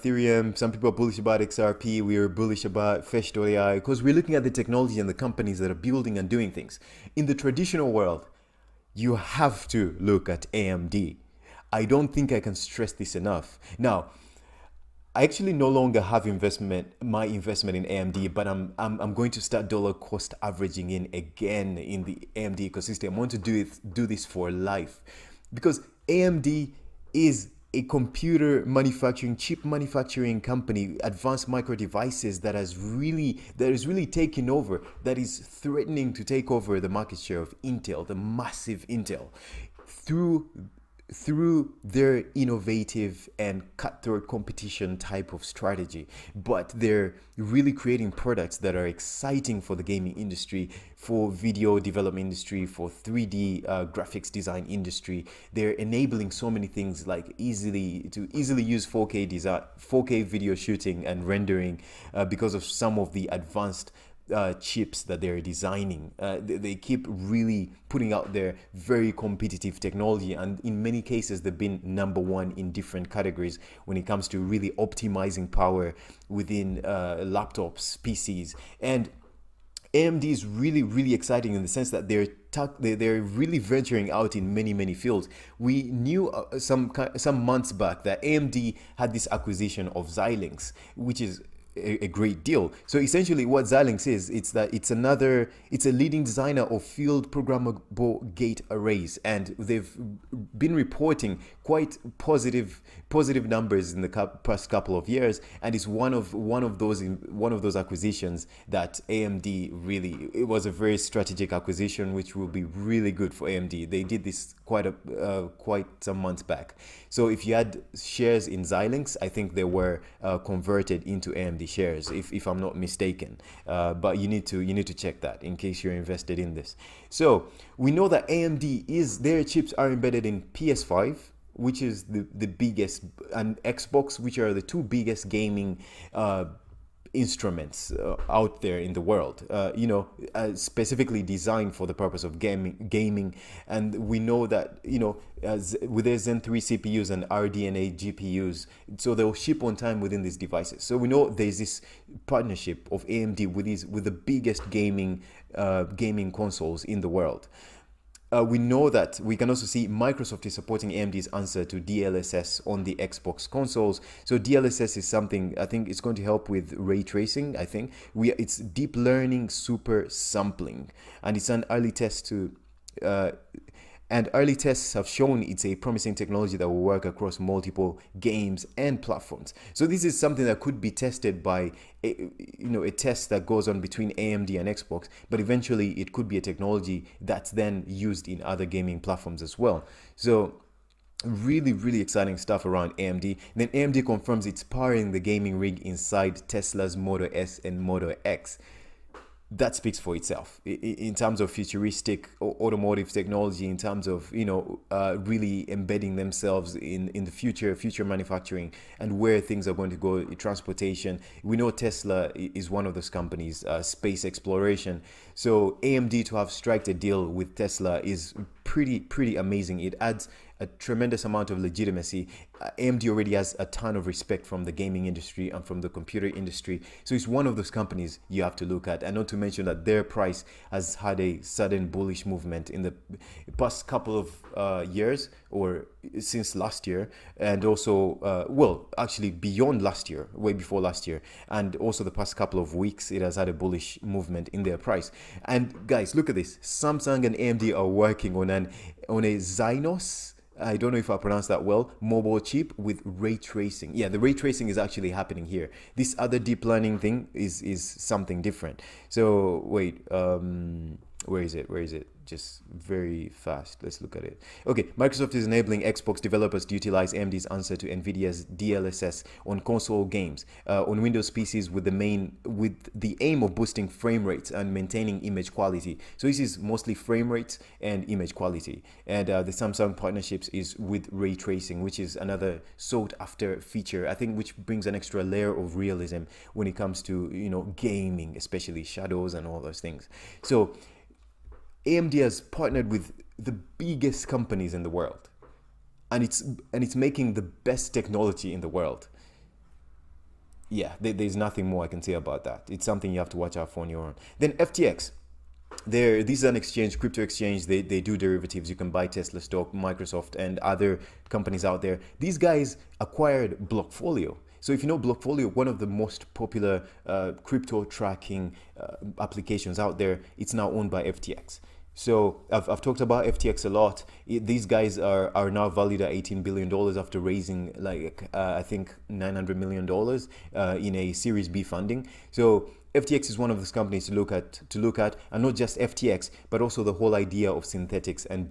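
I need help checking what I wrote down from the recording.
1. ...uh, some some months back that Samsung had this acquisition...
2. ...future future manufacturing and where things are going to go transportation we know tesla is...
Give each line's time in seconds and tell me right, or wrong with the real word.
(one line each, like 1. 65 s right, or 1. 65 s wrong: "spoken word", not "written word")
1. 86 s wrong: "AMD", not "Samsung"
2. 207 s right.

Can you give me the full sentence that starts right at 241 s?
And also the past couple of weeks, it has had a bullish movement in their price.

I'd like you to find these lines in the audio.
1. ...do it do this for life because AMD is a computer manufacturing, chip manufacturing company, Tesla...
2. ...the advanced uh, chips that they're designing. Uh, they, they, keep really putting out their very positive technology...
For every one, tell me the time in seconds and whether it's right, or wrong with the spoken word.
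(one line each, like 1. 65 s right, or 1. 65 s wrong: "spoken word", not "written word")
1. 23 s wrong: "Advanced", not "Tesla"
2. 63 s wrong: "competitive", not "positive".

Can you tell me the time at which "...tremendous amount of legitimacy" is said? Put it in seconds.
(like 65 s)
220 s.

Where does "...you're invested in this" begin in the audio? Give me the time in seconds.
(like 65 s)
125 s.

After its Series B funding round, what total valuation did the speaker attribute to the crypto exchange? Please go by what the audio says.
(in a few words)
$18 billion.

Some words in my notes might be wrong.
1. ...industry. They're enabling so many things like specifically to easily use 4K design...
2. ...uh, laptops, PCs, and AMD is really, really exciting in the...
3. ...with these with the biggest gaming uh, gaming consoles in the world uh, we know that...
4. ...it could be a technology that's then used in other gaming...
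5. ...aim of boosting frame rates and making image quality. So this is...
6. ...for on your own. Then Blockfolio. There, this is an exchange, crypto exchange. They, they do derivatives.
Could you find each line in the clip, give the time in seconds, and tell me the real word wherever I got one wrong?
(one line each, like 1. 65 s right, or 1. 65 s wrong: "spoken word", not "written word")
1. 54 s wrong: "easily", not "specifically"
2. 76 s right
3. 153 s right
4. 185 s right
5. 273 s wrong: "maintaining", not "making"
6. 303 s wrong: "FTX", not "Blockfolio".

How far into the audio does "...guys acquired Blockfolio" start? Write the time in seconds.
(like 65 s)
312 s.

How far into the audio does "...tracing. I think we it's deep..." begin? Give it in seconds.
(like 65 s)
167 s.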